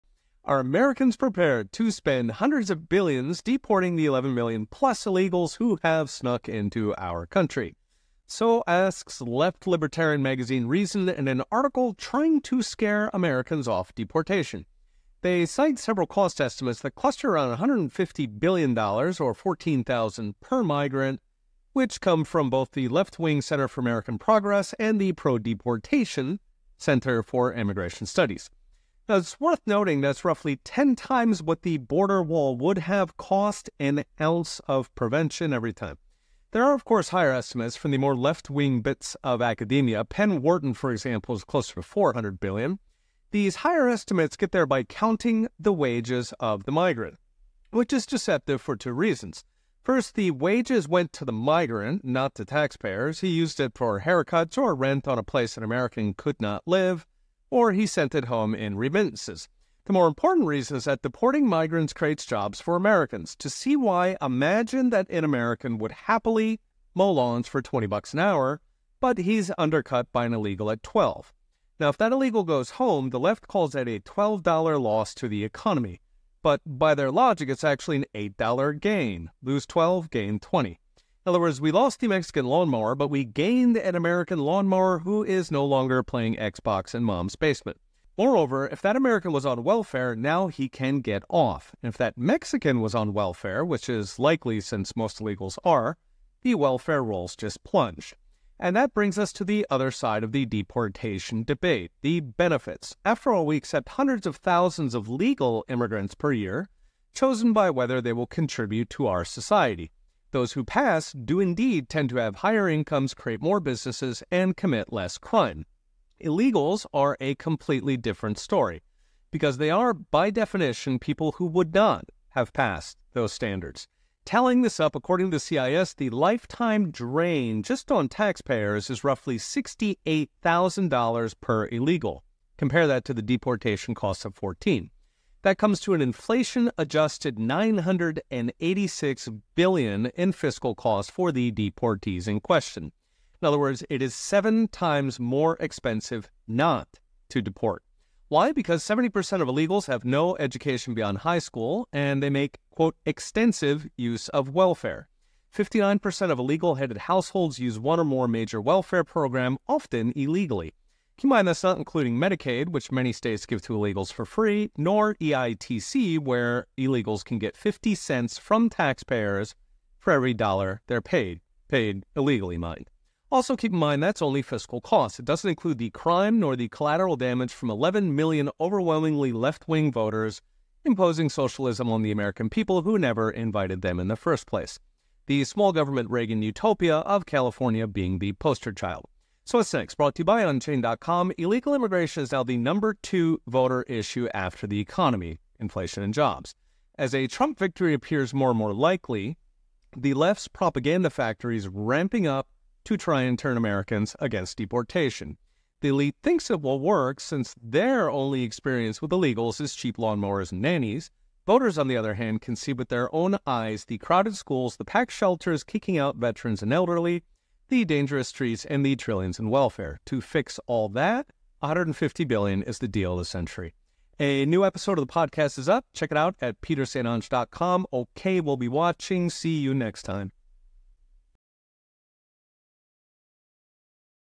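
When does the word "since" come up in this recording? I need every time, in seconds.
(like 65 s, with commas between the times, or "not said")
94 s, 207 s.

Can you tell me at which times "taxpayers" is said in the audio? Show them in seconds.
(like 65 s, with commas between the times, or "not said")
52 s, 128 s, 168 s.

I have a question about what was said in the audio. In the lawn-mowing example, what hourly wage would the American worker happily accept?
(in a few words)
$20.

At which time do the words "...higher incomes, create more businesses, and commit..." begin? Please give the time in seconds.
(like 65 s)
112 s.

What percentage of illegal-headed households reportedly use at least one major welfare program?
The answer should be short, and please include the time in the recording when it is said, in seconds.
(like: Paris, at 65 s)
59%, at 155 s.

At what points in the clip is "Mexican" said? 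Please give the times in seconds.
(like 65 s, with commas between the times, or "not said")
82 s, 92 s.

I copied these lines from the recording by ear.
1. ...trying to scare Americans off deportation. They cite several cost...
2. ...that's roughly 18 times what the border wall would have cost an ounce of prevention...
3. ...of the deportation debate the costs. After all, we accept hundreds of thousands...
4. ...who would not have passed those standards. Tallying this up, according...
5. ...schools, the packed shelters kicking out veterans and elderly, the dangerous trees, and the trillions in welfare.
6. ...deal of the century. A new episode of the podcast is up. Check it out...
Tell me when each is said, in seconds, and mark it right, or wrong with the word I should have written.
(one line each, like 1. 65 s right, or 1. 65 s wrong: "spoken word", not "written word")
1. 11 s right
2. 29 s wrong: "10", not "18"
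3. 100 s wrong: "benefits", not "costs"
4. 121 s right
5. 214 s right
6. 222 s right.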